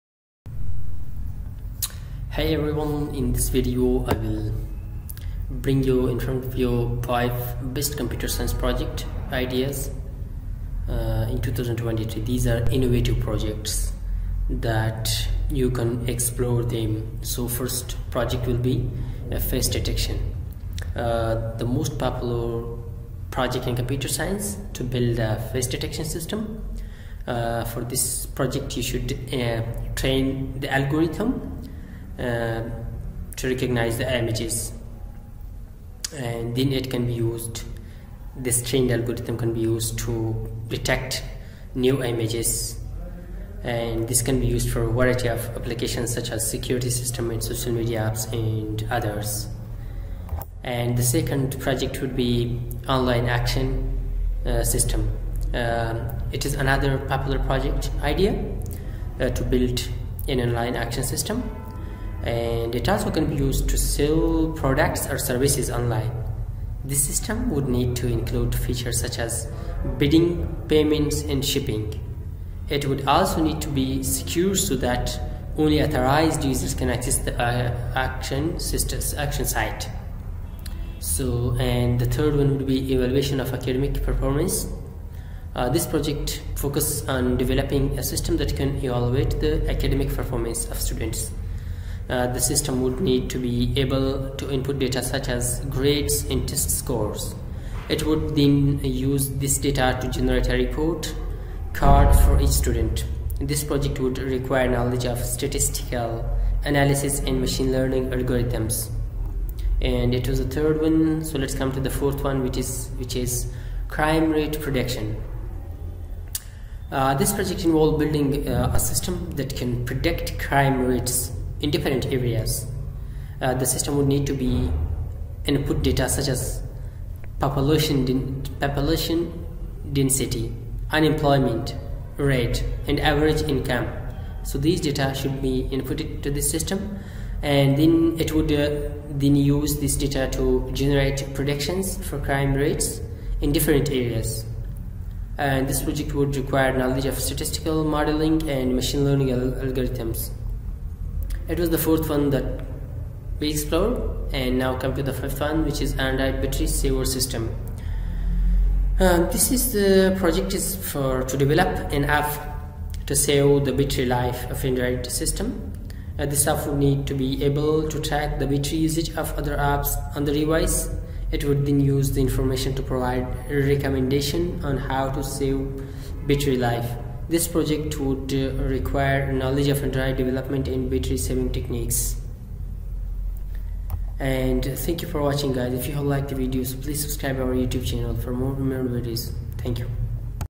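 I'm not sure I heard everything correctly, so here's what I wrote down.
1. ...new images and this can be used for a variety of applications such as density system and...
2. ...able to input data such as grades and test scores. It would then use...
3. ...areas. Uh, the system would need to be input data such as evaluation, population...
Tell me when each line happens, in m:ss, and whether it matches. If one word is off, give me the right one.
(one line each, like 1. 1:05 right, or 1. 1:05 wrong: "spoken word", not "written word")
1. 0:41 wrong: "security", not "density"
2. 1:33 right
3. 2:02 wrong: "population", not "evaluation".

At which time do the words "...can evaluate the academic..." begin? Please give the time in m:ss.
1:28.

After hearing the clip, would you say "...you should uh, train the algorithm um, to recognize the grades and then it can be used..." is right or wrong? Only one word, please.
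wrong.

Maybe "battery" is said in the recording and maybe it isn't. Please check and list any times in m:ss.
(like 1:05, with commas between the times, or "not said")
2:36, 2:43, 2:48, 2:56, 3:00.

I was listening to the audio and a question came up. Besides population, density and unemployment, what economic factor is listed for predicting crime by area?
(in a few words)
Average income.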